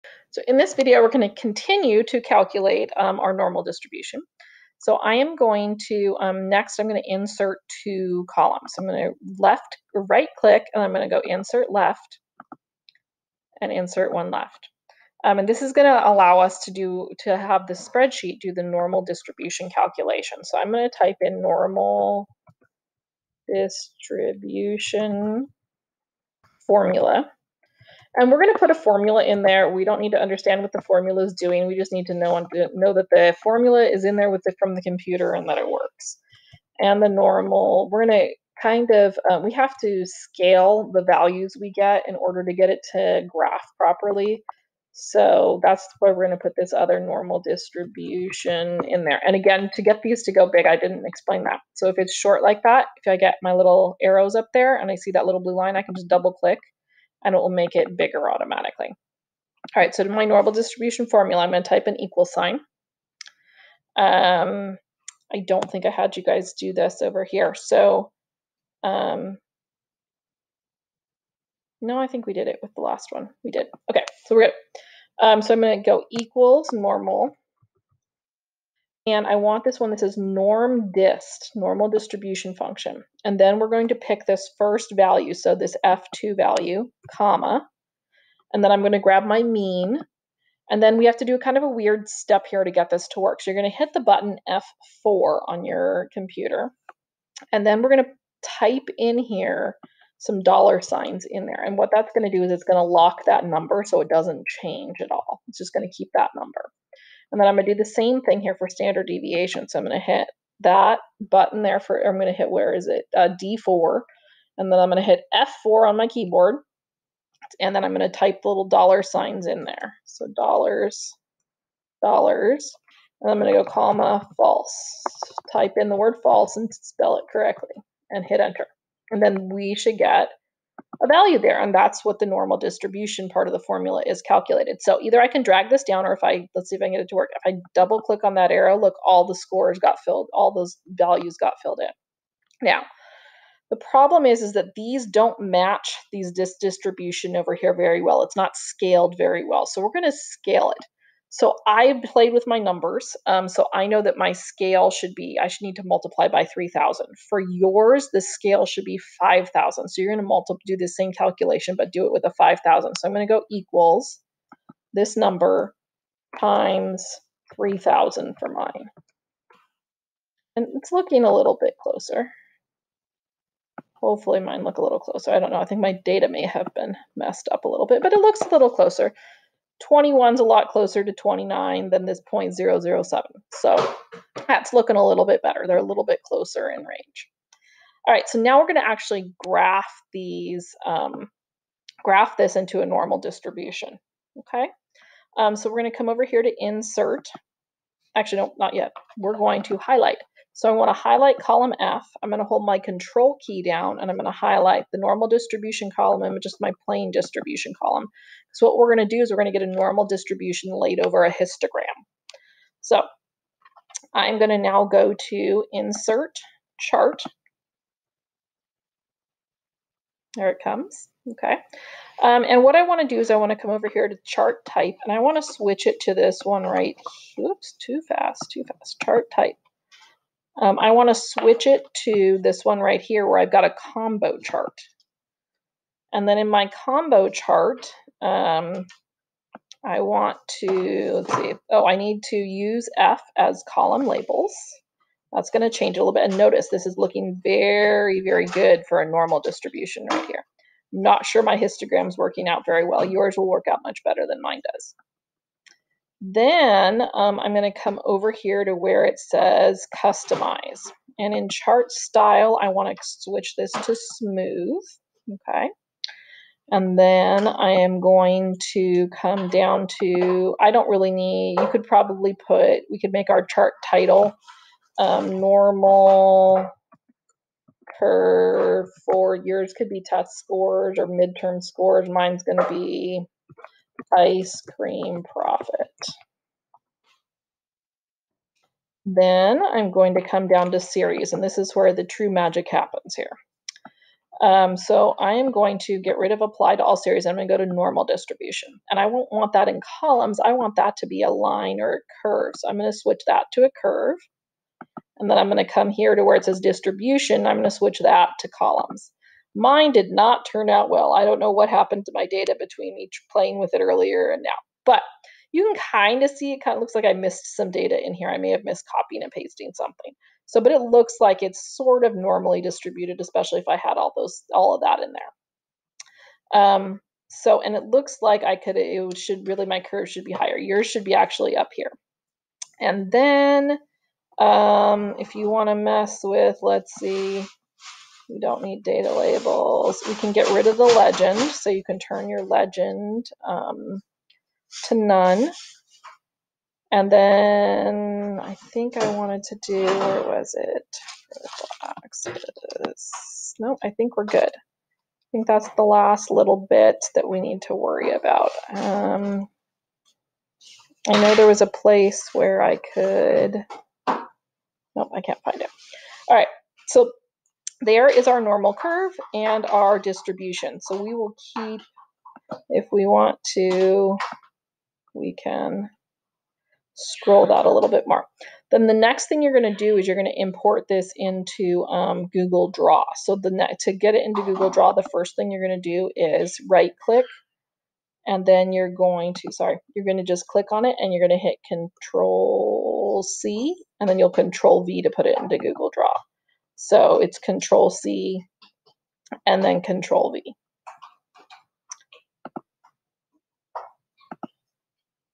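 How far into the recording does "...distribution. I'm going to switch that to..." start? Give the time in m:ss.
5:06.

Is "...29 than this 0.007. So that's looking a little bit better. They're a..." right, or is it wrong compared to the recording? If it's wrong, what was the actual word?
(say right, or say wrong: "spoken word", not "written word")
right.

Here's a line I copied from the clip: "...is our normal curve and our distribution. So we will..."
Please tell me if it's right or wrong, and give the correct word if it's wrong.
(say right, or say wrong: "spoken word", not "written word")
right.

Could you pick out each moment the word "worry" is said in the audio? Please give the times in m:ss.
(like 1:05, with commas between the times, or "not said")
5:57.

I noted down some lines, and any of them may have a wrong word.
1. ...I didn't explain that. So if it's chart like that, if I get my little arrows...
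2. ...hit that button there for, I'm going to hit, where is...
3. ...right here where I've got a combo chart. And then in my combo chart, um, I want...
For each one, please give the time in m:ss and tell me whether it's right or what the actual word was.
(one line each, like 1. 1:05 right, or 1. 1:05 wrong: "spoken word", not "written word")
1. 0:50 wrong: "short", not "chart"
2. 1:50 right
3. 3:52 right.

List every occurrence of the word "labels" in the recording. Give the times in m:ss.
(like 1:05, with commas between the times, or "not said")
4:04, 5:39.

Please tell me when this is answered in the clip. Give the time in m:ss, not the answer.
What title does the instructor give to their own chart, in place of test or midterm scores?
4:44.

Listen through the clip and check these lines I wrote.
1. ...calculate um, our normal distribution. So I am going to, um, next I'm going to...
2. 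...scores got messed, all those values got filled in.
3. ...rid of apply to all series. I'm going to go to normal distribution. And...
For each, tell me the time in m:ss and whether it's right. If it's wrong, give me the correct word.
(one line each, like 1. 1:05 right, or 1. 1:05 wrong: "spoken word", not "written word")
1. 0:02 right
2. 2:19 wrong: "filled", not "messed"
3. 4:56 right.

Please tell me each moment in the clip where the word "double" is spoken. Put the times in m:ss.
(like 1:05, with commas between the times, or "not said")
0:56, 2:17.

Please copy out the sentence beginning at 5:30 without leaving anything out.
Yours should be actually up here.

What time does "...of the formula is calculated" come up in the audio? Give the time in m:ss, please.
2:13.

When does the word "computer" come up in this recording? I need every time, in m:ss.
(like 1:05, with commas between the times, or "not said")
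0:34, 1:36.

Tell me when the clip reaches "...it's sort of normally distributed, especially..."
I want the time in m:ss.
5:21.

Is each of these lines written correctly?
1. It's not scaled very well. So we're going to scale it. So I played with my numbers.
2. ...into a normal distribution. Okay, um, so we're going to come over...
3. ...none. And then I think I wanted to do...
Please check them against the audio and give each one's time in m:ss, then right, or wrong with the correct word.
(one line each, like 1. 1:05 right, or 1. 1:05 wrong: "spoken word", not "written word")
1. 2:28 right
2. 3:12 right
3. 5:44 right.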